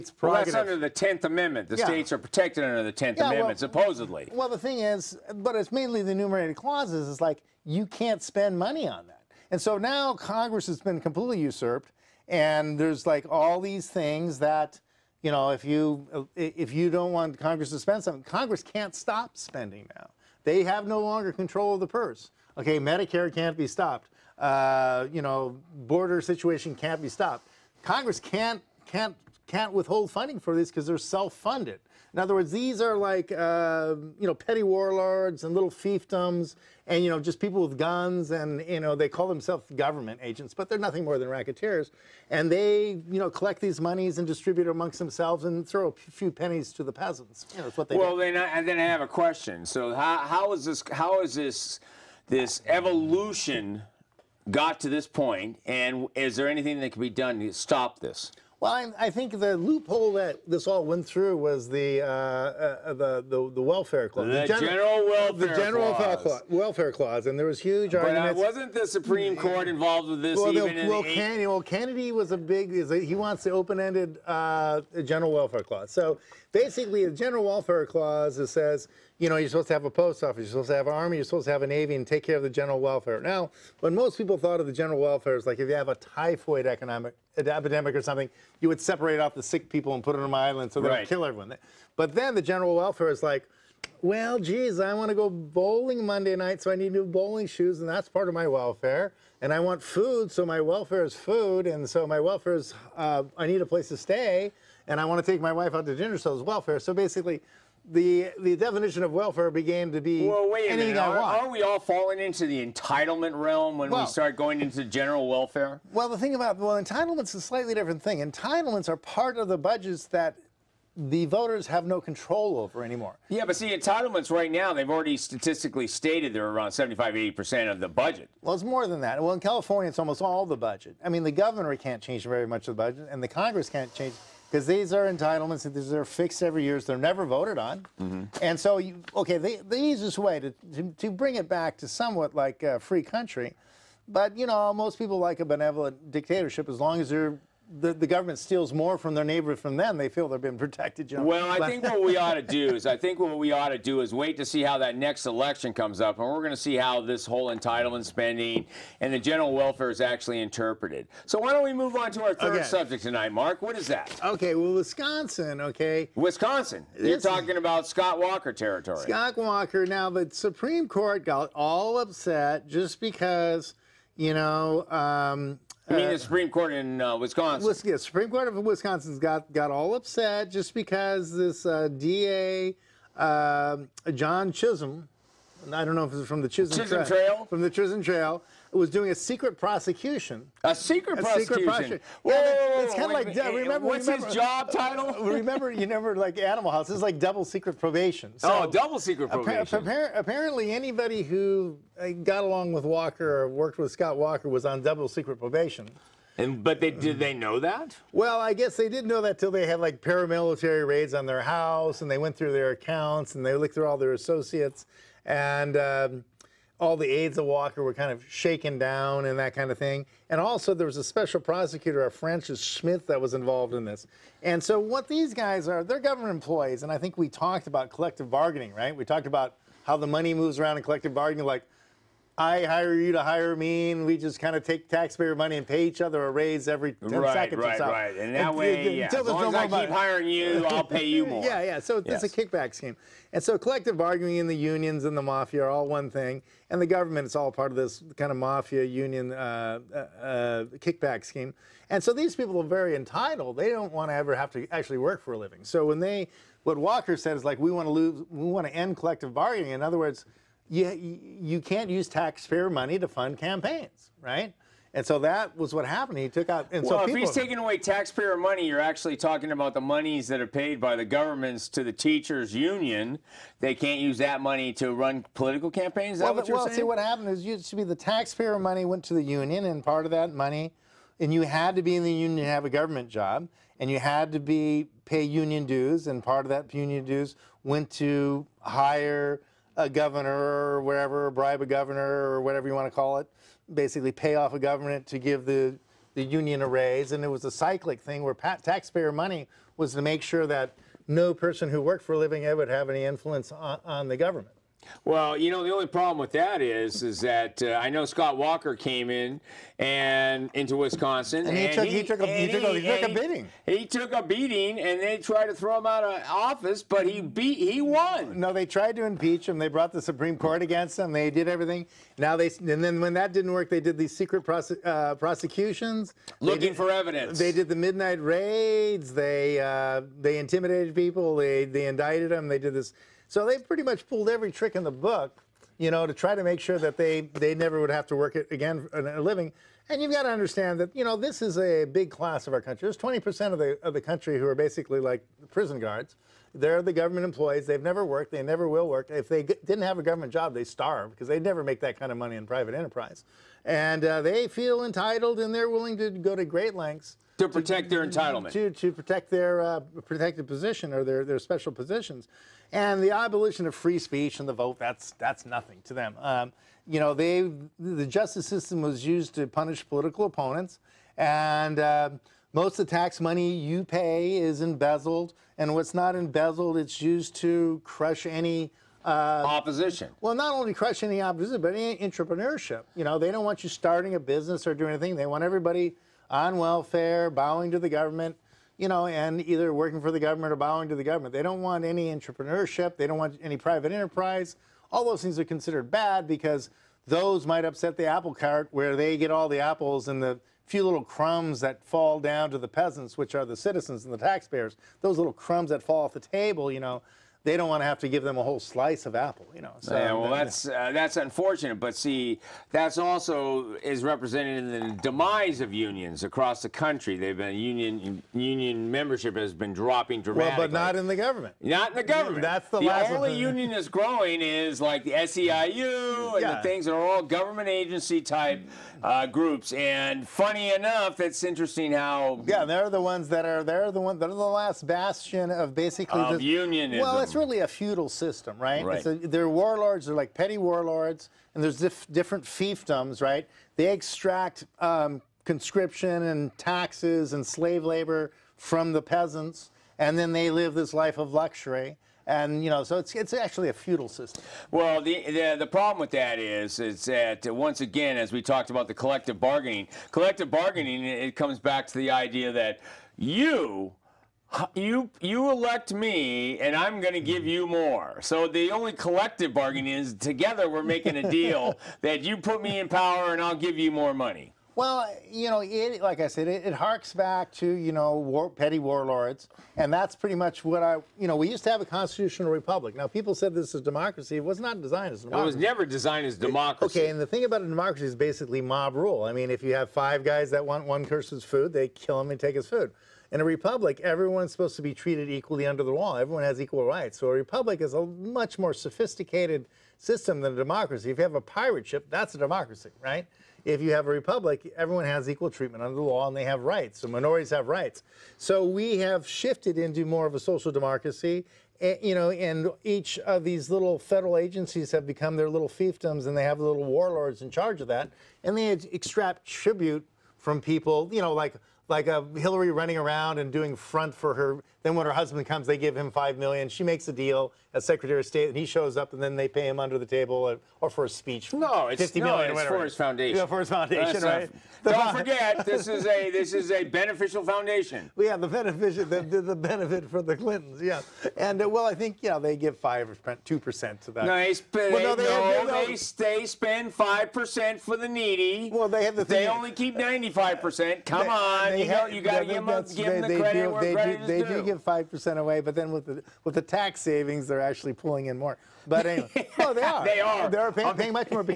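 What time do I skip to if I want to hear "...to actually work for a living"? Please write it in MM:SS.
04:14.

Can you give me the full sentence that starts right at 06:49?
So yeah, well, that's uh, that's unfortunate, but see, that's also is represented in the demise of unions across the country.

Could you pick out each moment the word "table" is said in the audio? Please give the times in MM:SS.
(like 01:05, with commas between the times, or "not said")
06:46, 08:50.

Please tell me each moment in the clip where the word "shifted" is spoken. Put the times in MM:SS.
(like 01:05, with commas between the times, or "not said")
08:29.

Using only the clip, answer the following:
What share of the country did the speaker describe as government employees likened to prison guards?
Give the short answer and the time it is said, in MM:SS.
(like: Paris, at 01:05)
20%, at 05:42.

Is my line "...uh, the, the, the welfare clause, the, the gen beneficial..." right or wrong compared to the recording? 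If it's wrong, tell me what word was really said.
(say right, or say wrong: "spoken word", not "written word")
wrong: "general", not "beneficial".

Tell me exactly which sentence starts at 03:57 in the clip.
Right, And that and, way, and, yeah.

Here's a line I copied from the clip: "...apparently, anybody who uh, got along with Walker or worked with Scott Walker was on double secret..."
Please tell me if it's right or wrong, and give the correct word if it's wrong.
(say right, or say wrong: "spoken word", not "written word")
right.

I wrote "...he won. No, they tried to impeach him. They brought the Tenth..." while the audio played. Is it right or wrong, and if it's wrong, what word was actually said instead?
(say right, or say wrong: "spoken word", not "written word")
wrong: "Supreme", not "Tenth".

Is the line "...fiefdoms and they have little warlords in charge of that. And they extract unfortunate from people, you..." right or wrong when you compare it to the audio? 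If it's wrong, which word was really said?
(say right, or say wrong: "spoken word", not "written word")
wrong: "tribute", not "unfortunate".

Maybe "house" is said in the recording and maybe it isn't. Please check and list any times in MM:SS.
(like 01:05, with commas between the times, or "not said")
03:16, 03:31.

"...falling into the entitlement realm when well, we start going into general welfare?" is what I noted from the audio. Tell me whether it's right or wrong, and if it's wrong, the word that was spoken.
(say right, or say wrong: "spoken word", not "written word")
right.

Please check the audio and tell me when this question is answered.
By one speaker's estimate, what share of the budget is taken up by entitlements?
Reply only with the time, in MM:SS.
02:06.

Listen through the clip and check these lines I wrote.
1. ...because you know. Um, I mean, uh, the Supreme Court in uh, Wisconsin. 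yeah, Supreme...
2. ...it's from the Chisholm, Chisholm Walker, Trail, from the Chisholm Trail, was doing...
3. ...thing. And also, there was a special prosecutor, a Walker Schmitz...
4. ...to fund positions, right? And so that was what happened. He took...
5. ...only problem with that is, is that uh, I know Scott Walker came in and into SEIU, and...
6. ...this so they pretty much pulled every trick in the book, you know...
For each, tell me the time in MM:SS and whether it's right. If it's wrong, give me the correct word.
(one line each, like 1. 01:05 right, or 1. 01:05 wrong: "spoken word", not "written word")
1. 02:52 right
2. 03:06 wrong: "Trail", not "Walker"
3. 03:39 wrong: "Francis", not "Walker"
4. 04:22 wrong: "campaigns", not "positions"
5. 05:05 wrong: "Wisconsin", not "SEIU"
6. 05:32 right.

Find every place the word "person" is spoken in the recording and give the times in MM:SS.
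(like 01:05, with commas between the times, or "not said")
05:01, 08:11.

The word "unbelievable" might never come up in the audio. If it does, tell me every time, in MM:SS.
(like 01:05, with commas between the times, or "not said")
not said.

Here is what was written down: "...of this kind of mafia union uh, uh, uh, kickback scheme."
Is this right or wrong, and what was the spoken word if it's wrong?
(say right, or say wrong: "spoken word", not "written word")
right.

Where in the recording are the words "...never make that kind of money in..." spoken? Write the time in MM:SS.
05:51.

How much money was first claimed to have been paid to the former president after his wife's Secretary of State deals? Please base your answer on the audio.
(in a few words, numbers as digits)
5 million.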